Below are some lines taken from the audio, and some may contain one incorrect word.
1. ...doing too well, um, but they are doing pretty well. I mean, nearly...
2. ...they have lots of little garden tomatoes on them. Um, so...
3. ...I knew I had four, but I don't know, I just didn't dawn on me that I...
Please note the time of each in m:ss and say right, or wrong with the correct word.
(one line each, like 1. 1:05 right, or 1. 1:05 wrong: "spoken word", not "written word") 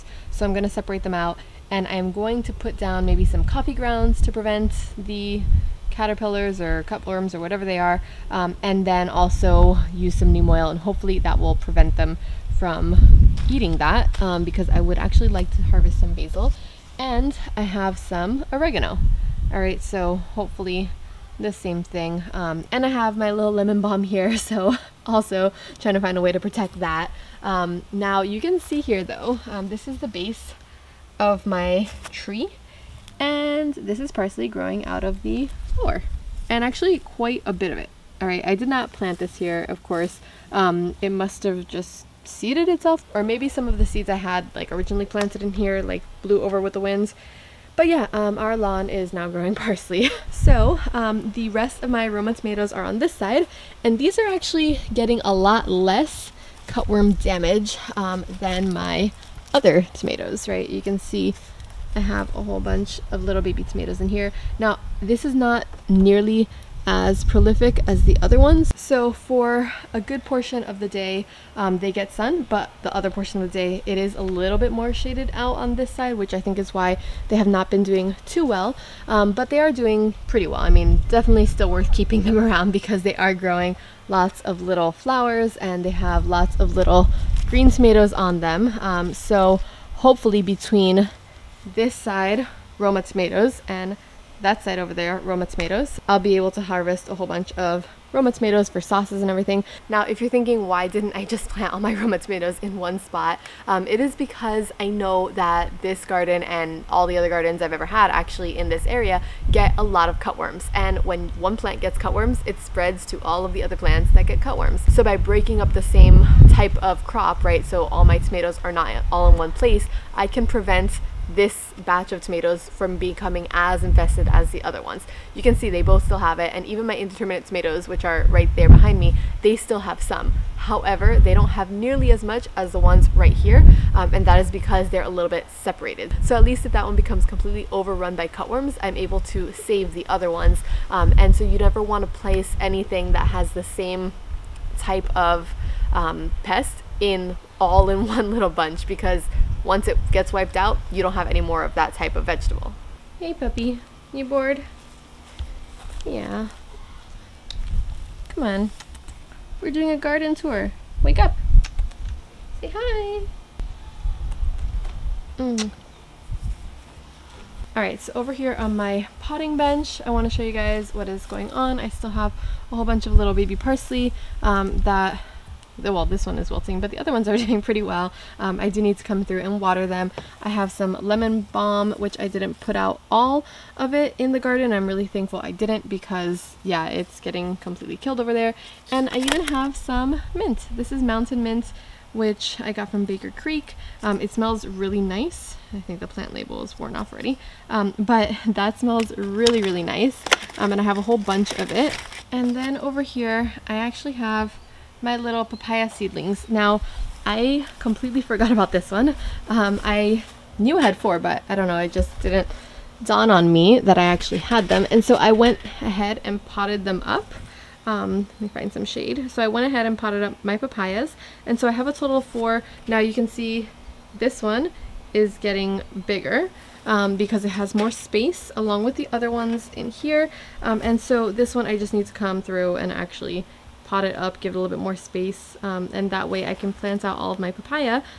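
1. 1:17 wrong: "definitely", not "nearly"
2. 1:25 wrong: "green", not "garden"
3. 3:29 right.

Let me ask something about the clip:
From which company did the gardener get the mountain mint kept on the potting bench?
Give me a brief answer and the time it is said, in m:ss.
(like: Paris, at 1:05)
Baker Creek, at 3:13.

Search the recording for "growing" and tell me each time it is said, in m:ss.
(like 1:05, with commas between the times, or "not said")
0:34, 0:49, 1:23.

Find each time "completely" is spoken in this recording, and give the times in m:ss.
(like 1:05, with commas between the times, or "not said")
2:17, 3:07, 3:27.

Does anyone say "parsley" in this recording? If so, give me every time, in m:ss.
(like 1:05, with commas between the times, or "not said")
0:34, 0:49, 2:53.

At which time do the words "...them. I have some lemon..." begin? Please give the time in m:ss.
2:59.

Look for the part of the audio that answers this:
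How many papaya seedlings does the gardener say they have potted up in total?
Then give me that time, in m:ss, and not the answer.
3:41.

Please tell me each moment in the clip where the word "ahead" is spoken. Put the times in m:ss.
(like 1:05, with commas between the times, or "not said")
3:35, 3:39.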